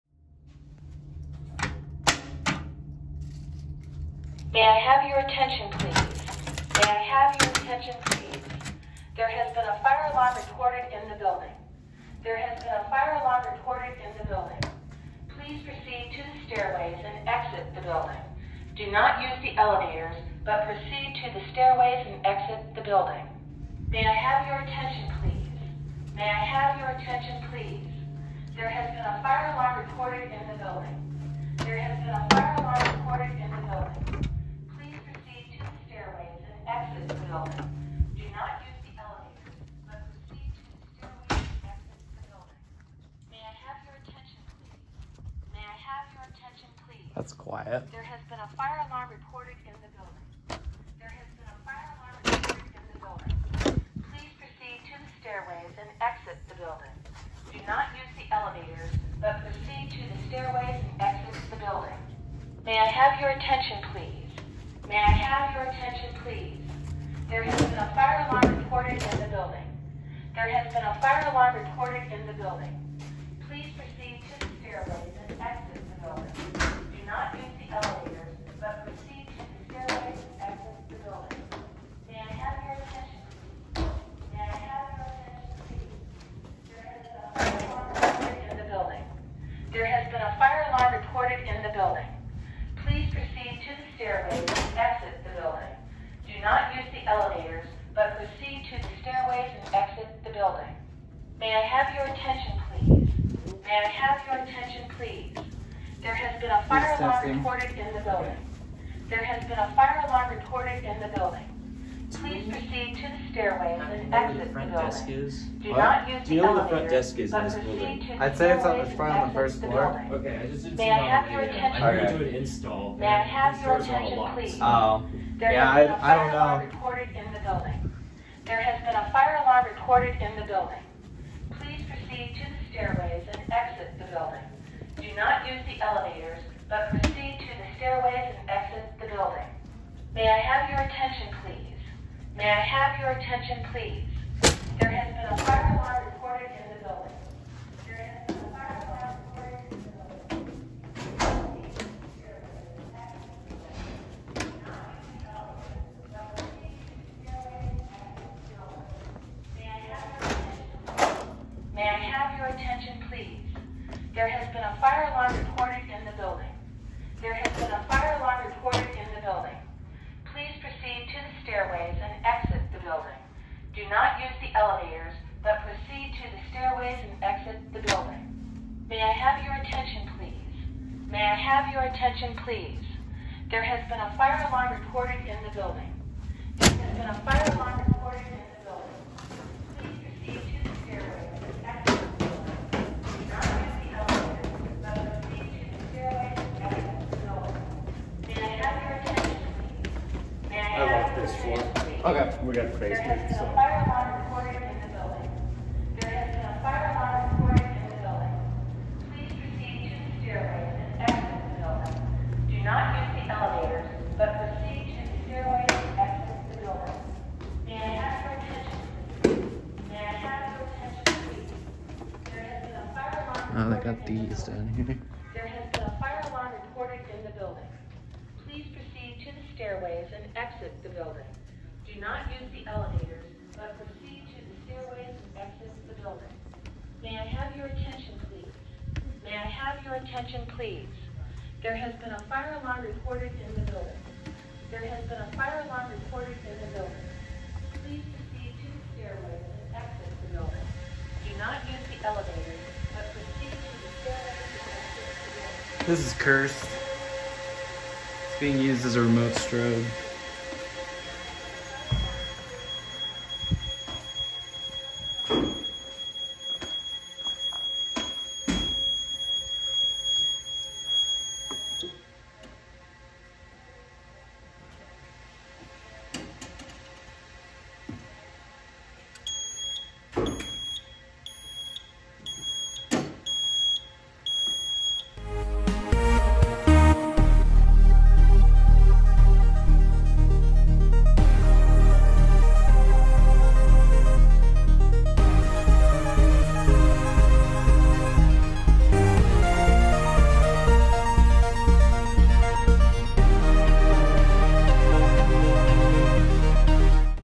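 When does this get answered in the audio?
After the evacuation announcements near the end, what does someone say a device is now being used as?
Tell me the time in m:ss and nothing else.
4:19.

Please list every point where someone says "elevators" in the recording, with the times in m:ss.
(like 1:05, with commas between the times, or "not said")
0:19, 0:58, 1:17, 2:15, 2:54, 3:33, 3:52, 4:12.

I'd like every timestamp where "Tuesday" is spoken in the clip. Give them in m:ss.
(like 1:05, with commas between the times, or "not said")
not said.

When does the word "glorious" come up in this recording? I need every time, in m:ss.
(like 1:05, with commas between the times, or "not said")
not said.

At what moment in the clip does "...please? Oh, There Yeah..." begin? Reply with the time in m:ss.
2:04.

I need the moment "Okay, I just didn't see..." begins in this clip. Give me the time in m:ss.
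2:00.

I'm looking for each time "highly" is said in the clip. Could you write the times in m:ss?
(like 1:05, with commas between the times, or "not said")
not said.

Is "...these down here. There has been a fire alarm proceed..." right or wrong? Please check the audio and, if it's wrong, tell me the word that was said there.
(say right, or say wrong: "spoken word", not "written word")
wrong: "recorded", not "proceed".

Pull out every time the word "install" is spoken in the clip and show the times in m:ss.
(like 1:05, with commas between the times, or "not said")
2:02.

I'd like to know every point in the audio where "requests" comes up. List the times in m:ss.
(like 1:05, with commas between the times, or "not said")
not said.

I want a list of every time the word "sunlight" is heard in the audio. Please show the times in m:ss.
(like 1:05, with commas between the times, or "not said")
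not said.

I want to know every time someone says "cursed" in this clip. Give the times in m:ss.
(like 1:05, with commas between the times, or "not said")
4:16.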